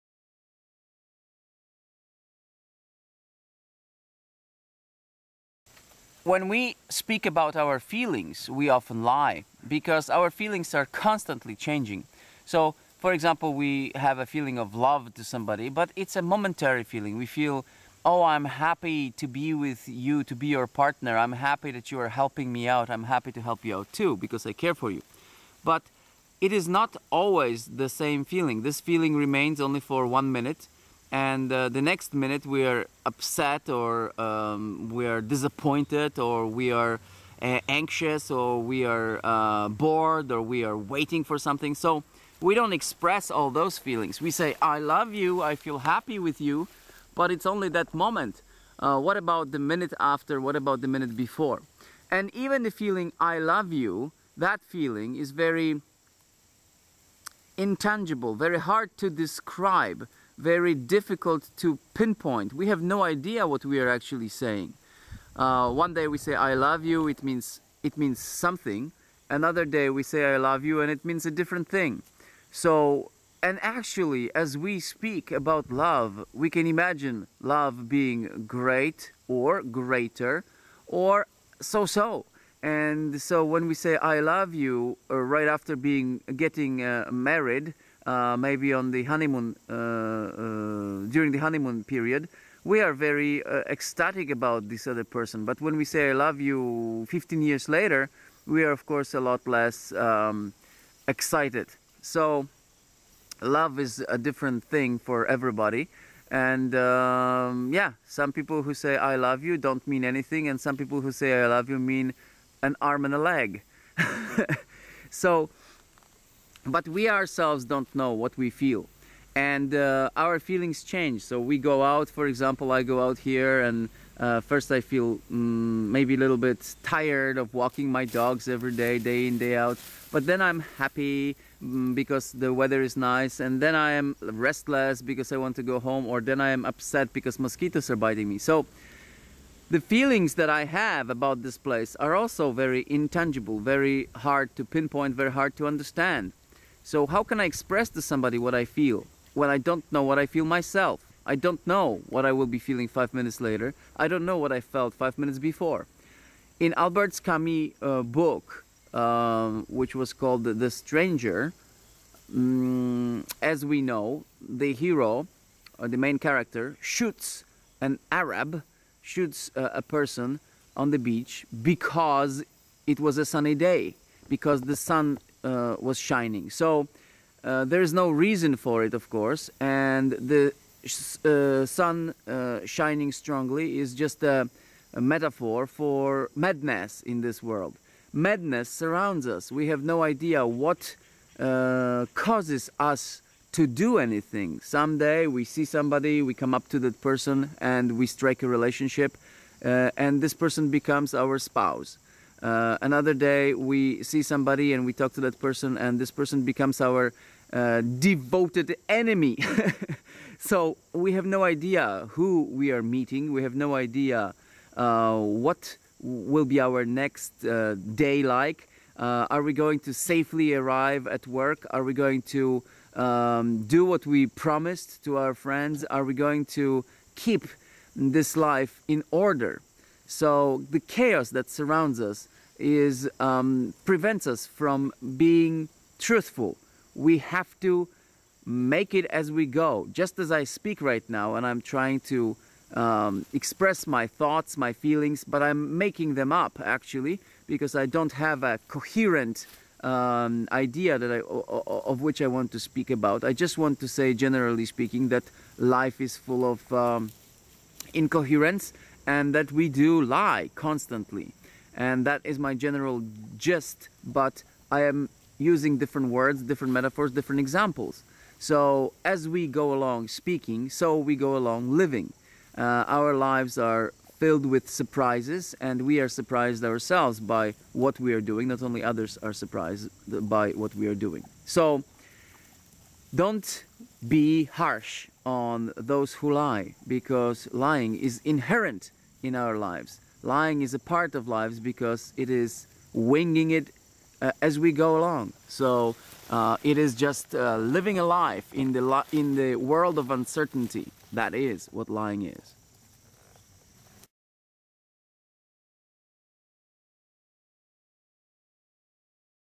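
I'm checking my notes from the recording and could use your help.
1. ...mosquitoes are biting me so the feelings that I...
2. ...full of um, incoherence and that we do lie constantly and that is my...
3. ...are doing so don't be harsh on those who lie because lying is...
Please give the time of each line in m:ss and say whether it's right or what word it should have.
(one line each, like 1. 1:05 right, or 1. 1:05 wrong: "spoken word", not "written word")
1. 2:17 right
2. 4:16 right
3. 4:40 right.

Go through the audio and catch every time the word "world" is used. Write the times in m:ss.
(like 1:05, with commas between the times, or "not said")
3:07, 4:59.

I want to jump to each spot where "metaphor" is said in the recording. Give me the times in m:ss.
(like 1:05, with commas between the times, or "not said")
3:05, 4:26.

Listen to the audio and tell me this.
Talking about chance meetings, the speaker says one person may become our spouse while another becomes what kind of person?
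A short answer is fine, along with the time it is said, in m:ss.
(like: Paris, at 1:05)
devoted enemy, at 3:27.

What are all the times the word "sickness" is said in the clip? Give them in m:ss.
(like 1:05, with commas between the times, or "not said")
not said.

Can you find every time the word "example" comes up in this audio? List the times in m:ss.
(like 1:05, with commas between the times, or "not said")
0:13, 2:02, 4:27.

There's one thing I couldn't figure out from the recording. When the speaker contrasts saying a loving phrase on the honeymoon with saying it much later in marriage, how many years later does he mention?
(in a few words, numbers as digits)
15.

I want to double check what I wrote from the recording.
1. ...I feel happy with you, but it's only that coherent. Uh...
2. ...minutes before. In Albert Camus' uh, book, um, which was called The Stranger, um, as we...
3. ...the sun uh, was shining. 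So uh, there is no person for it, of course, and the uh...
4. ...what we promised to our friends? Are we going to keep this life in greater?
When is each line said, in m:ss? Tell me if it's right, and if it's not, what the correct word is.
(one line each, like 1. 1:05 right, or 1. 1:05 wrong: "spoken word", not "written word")
1. 0:45 wrong: "moment", not "coherent"
2. 2:35 right
3. 2:54 wrong: "reason", not "person"
4. 3:43 wrong: "order", not "greater".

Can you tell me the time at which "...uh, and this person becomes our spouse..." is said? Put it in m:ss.
3:19.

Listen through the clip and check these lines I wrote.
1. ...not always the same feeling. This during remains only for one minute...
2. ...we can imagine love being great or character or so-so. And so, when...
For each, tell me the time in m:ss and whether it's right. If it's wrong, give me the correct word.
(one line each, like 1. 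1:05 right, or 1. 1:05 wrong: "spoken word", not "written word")
1. 0:26 wrong: "feeling", not "during"
2. 1:16 wrong: "greater", not "character".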